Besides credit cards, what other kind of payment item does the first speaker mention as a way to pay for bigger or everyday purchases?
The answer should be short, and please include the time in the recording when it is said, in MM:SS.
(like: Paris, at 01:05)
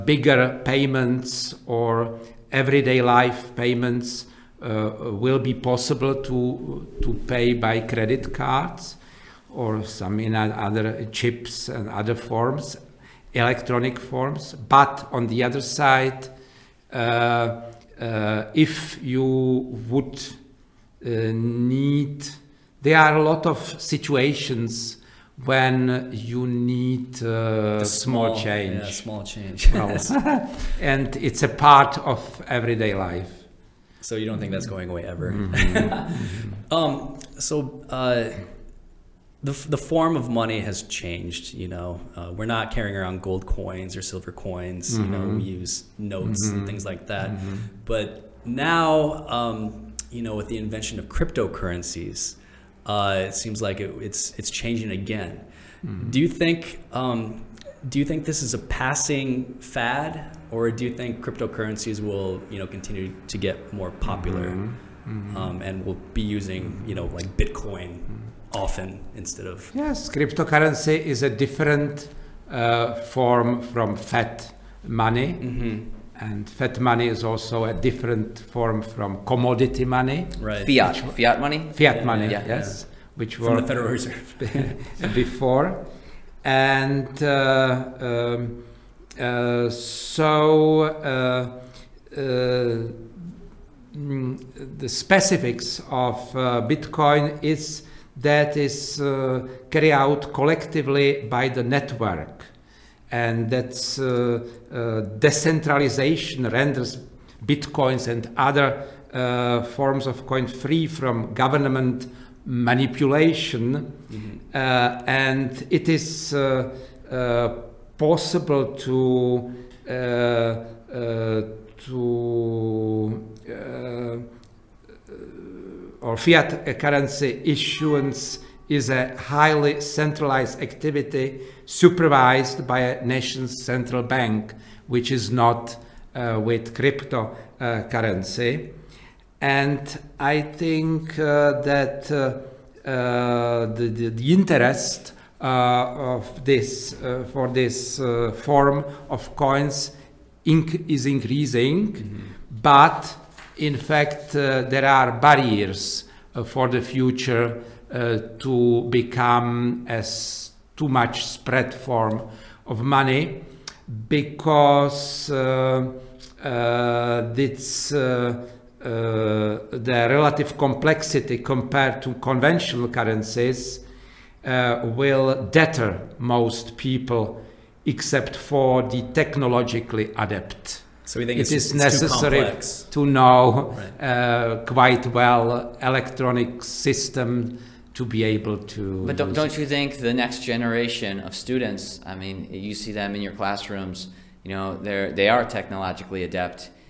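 chips, at 00:11.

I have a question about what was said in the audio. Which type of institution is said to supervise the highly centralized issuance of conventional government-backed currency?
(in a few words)
a nation's central bank.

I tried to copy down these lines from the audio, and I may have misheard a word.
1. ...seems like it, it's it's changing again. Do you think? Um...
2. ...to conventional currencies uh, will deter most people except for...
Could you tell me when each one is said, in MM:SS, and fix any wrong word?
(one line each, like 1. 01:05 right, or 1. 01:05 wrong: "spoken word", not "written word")
1. 00:53 right
2. 02:52 right.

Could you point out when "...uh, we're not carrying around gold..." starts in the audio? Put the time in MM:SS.
00:42.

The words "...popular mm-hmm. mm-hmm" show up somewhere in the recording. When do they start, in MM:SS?
01:03.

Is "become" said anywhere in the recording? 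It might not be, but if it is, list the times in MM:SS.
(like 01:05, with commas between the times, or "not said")
02:38.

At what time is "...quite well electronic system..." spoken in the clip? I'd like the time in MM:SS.
03:04.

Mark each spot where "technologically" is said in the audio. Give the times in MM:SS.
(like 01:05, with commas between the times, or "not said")
02:59, 03:15.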